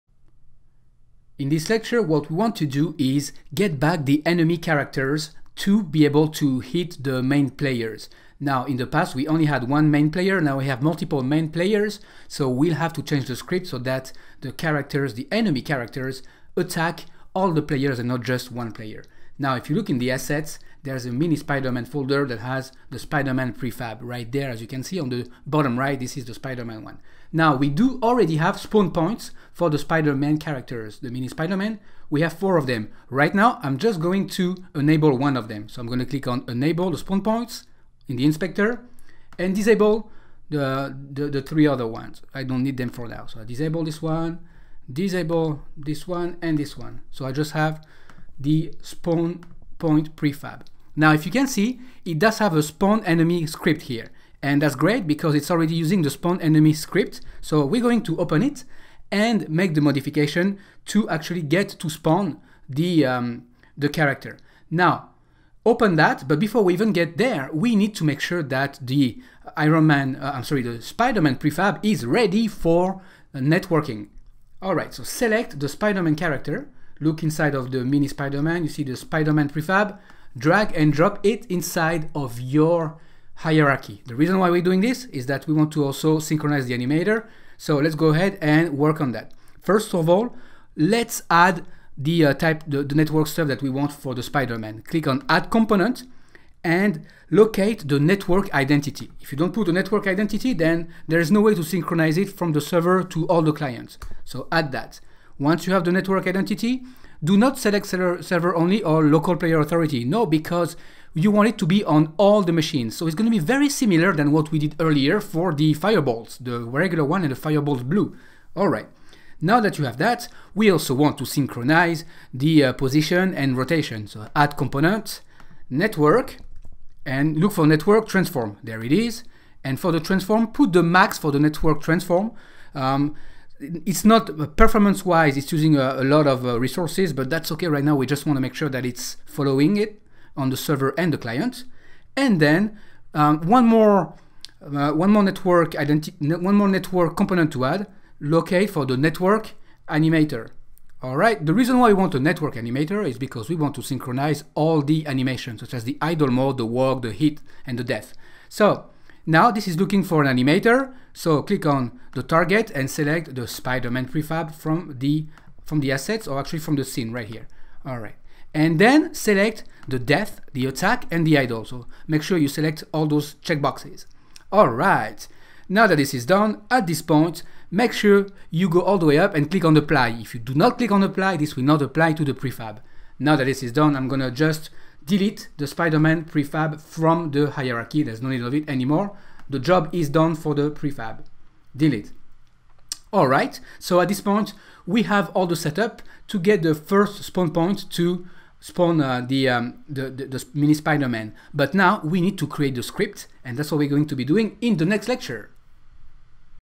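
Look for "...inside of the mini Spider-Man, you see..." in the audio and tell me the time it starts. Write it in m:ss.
1:17.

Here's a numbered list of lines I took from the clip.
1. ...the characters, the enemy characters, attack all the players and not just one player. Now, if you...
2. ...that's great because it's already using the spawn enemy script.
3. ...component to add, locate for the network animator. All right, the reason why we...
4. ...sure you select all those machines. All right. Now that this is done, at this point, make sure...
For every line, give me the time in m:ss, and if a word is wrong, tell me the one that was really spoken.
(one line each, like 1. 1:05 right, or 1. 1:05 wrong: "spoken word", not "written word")
1. 0:14 right
2. 0:54 right
3. 2:27 right
4. 2:52 wrong: "checkboxes", not "machines".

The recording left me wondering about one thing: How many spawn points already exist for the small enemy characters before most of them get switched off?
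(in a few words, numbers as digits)
4.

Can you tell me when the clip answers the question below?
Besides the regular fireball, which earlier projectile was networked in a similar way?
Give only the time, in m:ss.
1:57.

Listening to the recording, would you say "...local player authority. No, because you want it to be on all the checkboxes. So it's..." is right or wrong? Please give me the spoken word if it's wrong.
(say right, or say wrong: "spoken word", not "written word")
wrong: "machines", not "checkboxes".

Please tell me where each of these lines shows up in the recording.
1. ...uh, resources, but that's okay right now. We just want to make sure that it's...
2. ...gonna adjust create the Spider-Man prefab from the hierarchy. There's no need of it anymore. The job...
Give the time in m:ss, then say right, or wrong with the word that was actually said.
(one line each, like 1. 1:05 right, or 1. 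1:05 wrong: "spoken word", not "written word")
1. 2:16 right
2. 3:04 wrong: "delete", not "create".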